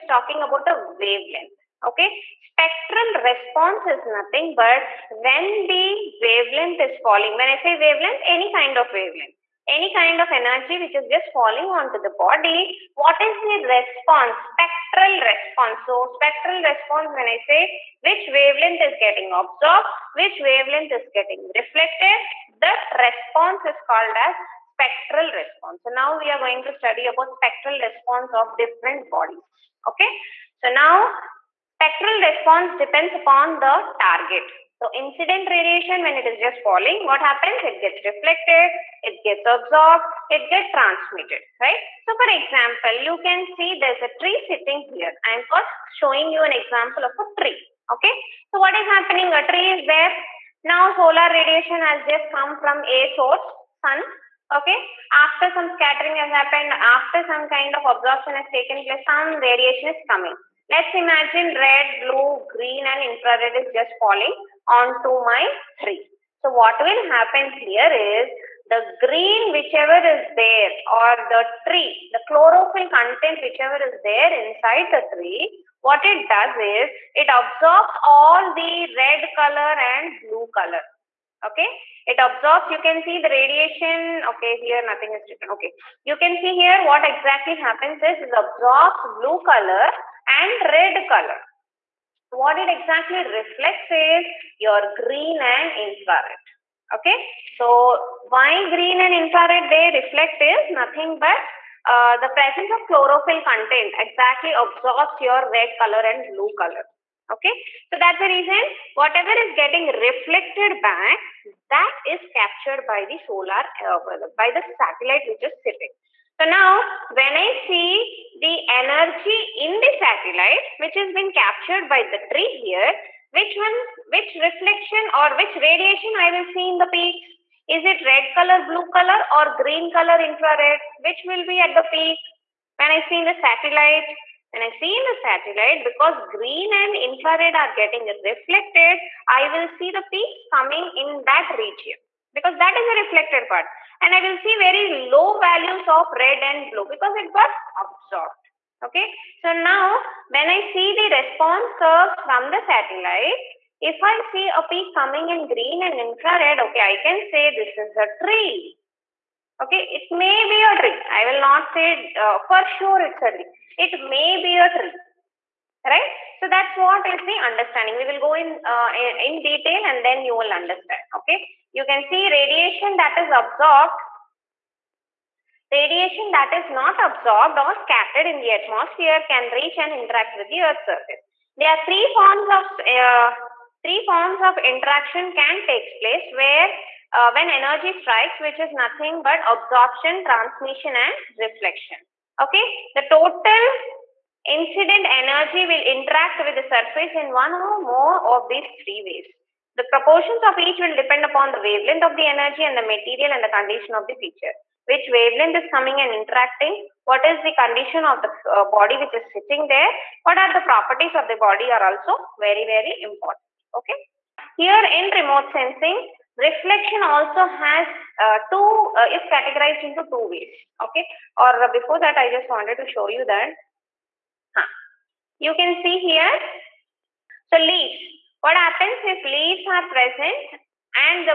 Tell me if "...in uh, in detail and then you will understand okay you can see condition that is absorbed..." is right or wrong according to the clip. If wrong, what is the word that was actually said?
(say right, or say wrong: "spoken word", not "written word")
wrong: "radiation", not "condition".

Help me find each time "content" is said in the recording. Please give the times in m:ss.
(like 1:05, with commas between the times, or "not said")
1:12, 1:43.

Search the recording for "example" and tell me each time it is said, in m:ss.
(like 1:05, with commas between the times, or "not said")
0:42, 0:46.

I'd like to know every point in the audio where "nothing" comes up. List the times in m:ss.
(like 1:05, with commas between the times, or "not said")
0:04, 1:24, 1:40, 3:08.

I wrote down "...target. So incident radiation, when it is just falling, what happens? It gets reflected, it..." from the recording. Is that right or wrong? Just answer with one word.
right.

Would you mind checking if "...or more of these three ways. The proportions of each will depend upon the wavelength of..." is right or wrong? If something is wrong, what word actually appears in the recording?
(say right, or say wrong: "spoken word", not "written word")
right.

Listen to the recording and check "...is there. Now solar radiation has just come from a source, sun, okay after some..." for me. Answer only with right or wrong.
right.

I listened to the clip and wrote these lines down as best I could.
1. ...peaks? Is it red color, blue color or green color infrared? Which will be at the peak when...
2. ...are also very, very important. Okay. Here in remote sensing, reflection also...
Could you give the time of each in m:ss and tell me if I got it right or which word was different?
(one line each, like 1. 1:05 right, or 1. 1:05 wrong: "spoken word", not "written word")
1. 2:06 right
2. 3:31 right.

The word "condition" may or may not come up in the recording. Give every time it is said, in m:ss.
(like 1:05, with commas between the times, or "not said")
3:23, 3:27.